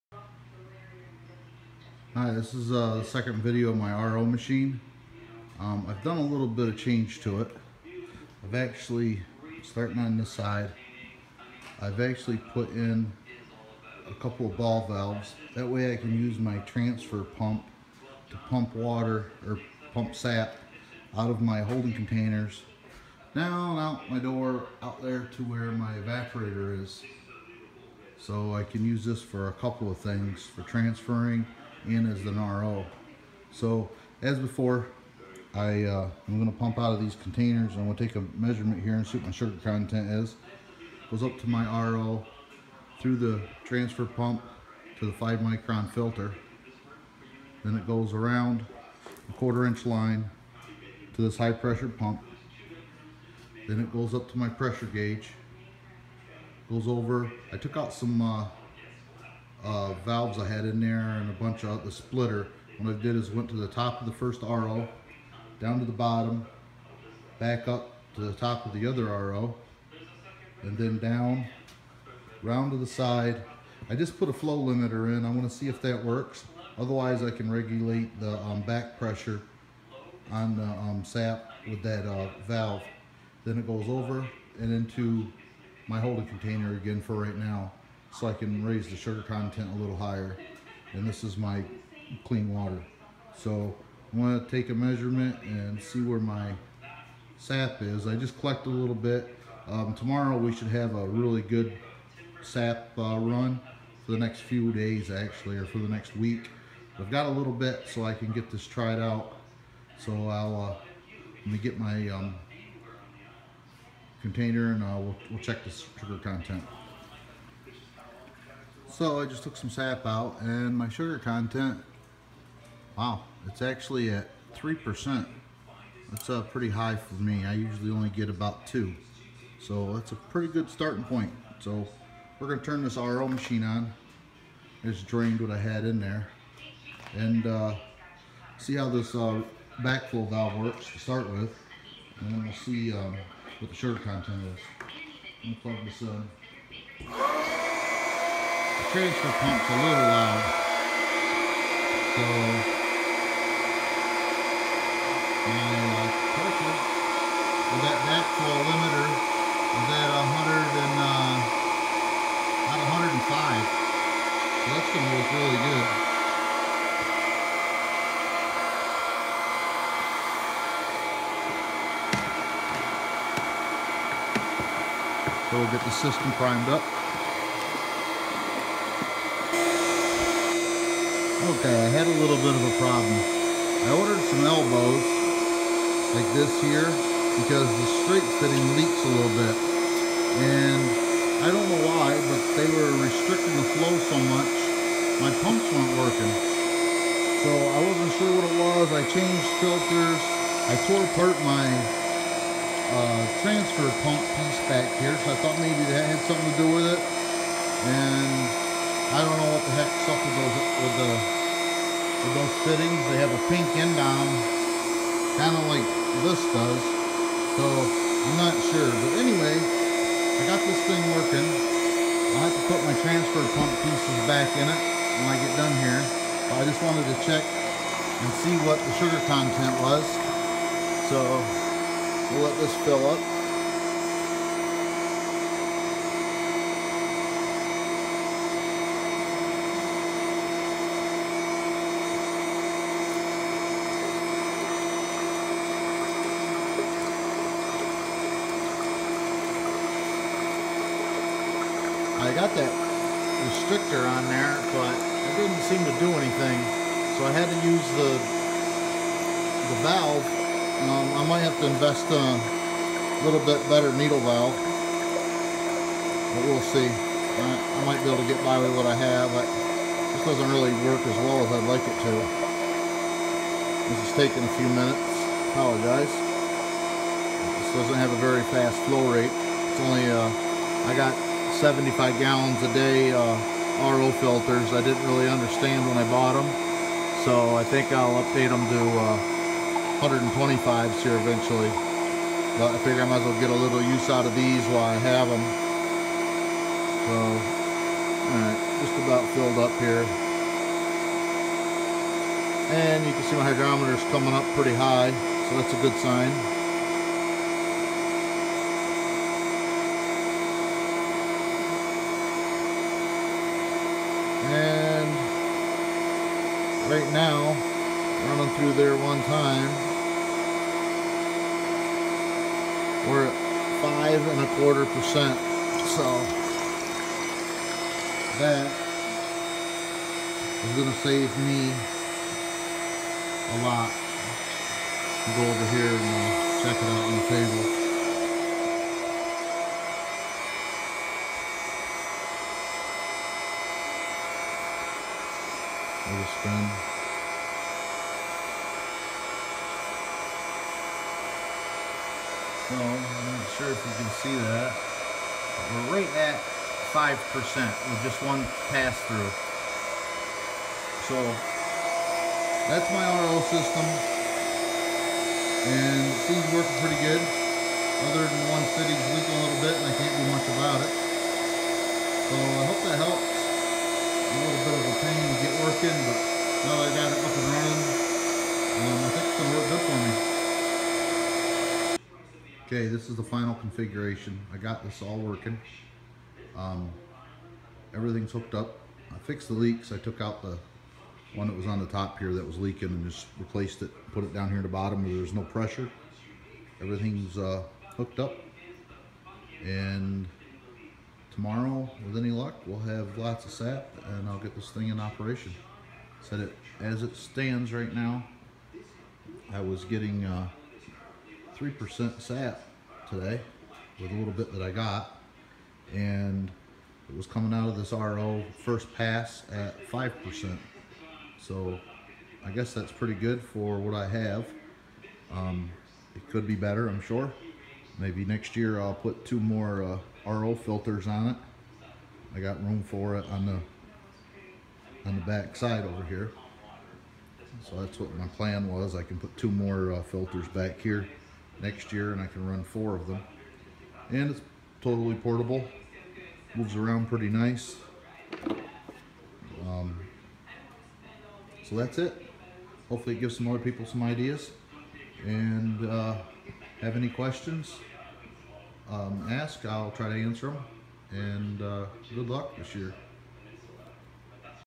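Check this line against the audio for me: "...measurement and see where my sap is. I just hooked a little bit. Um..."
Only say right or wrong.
wrong.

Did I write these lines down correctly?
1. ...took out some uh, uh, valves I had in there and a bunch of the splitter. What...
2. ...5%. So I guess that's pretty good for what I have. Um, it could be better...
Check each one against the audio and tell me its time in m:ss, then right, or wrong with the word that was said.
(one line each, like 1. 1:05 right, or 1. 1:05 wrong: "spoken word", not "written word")
1. 0:57 right
2. 6:59 right.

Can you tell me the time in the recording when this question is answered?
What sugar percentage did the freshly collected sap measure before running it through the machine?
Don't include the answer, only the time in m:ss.
2:03.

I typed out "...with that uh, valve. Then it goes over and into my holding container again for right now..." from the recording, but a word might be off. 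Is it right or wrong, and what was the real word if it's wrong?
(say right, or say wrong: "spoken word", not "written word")
right.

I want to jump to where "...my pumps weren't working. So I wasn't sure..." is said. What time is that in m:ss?
3:15.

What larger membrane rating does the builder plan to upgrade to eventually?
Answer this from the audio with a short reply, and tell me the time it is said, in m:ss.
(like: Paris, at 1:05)
125, at 4:50.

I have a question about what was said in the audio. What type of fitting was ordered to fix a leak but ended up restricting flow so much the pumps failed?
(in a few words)
elbows.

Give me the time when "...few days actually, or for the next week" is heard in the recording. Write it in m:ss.
1:44.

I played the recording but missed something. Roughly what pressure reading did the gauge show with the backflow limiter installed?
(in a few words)
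105.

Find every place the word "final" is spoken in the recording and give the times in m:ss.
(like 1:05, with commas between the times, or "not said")
6:23.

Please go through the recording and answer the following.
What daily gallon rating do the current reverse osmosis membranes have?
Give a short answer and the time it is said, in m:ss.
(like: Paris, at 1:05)
75 gallons a day, at 4:41.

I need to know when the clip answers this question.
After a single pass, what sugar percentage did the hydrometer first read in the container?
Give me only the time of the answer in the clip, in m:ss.
5:23.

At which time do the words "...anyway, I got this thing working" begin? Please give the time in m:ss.
3:39.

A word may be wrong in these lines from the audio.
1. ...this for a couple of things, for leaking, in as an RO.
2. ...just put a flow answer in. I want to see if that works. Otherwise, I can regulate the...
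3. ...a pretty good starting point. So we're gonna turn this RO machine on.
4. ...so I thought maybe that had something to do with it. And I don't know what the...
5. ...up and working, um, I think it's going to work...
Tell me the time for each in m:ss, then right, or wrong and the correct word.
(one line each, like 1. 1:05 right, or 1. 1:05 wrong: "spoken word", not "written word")
1. 0:29 wrong: "transferring", not "leaking"
2. 1:13 wrong: "limiter", not "answer"
3. 2:10 right
4. 3:25 right
5. 6:17 wrong: "running", not "working".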